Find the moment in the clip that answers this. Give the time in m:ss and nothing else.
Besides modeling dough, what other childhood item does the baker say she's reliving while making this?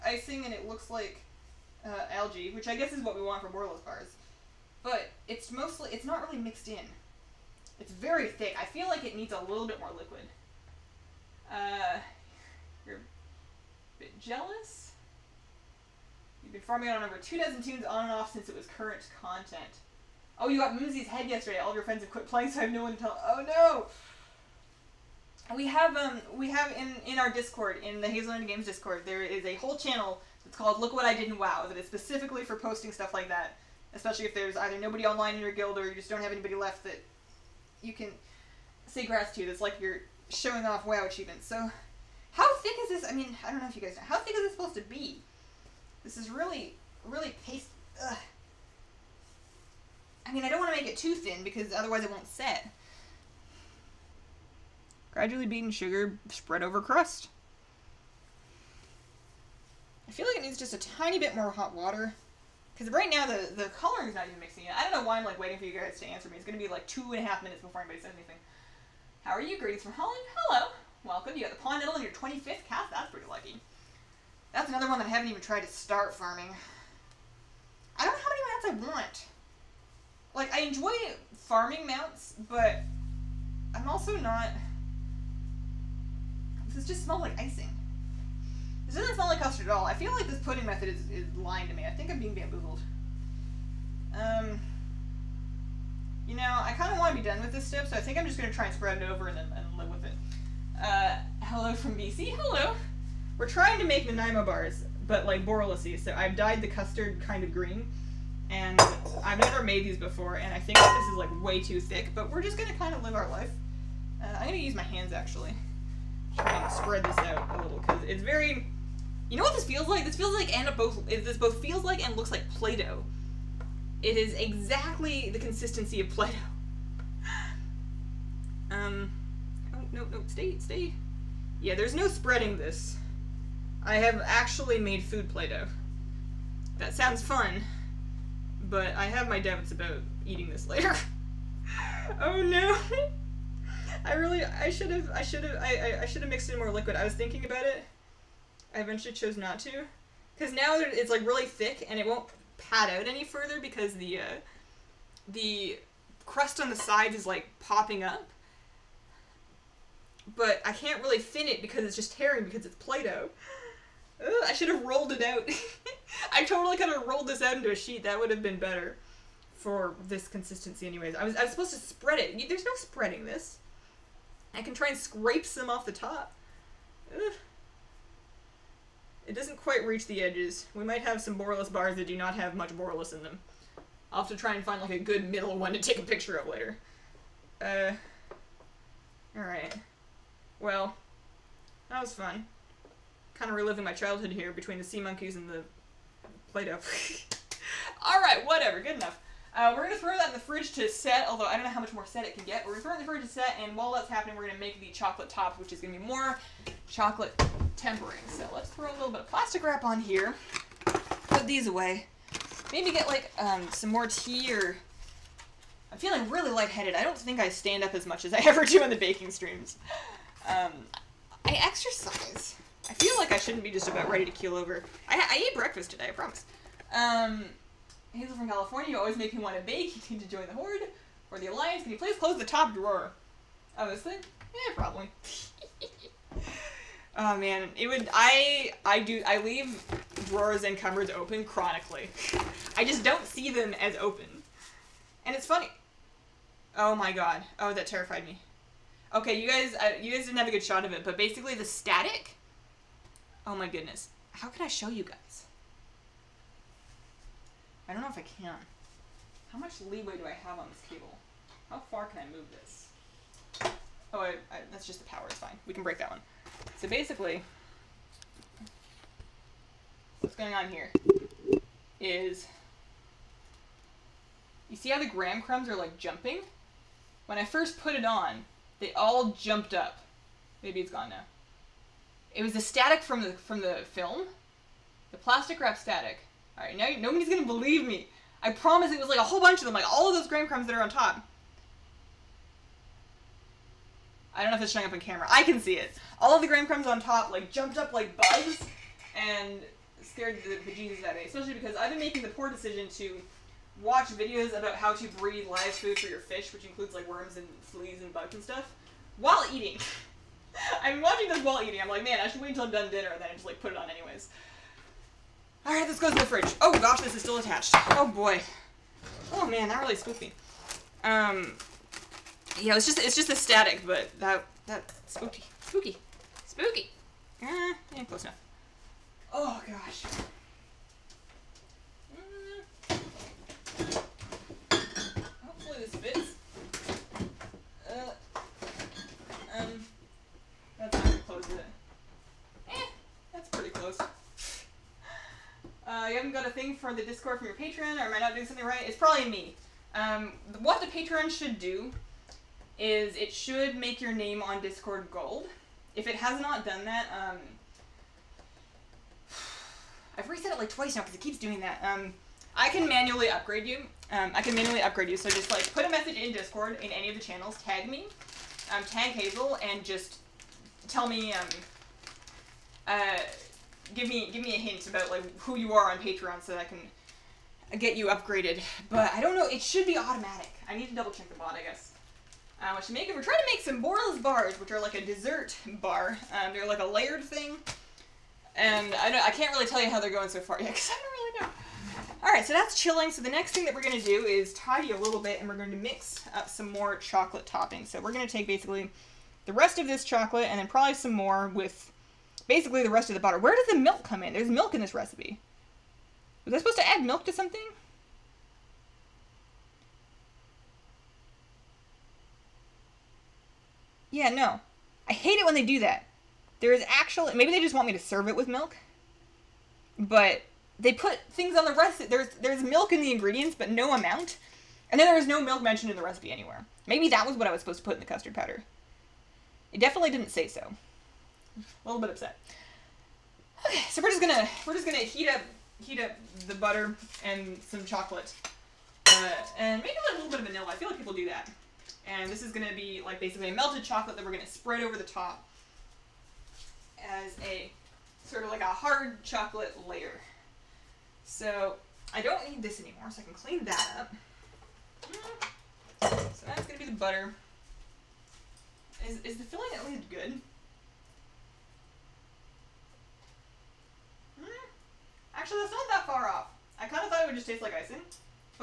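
3:14.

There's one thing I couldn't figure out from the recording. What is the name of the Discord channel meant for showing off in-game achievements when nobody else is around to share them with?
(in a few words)
look what i did in wow.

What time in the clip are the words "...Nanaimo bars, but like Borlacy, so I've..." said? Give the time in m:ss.
1:44.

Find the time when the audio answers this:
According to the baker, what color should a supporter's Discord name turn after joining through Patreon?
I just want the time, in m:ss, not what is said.
5:55.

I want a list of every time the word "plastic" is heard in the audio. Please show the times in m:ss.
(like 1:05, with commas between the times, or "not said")
3:29, 4:45.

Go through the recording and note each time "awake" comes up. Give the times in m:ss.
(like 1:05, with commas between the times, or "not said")
not said.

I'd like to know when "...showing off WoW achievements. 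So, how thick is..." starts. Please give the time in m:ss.
0:40.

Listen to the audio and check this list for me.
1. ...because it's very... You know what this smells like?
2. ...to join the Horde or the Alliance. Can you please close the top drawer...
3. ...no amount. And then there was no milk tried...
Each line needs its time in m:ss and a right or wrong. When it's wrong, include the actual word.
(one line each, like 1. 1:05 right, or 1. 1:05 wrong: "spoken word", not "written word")
1. 1:57 wrong: "feels", not "smells"
2. 3:50 right
3. 7:03 wrong: "mentioned", not "tried".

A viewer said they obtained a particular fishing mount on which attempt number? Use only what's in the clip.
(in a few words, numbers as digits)
25th.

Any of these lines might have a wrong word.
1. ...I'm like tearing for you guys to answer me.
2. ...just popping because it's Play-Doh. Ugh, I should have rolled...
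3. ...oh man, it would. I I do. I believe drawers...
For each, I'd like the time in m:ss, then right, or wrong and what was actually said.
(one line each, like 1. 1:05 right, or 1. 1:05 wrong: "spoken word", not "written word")
1. 1:05 wrong: "waiting", not "tearing"
2. 2:41 wrong: "tearing", not "popping"
3. 3:57 wrong: "leave", not "believe".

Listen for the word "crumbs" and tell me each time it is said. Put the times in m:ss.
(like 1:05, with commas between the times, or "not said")
4:35, 4:50, 4:56.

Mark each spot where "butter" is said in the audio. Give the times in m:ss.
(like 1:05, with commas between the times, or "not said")
6:43, 7:16, 7:36.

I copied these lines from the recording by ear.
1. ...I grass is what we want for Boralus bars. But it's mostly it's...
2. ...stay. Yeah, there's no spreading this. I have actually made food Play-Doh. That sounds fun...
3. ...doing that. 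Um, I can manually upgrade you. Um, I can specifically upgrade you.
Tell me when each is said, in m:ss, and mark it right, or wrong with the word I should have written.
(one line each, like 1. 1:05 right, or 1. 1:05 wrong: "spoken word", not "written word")
1. 0:02 wrong: "guess", not "grass"
2. 2:10 right
3. 6:01 wrong: "manually", not "specifically".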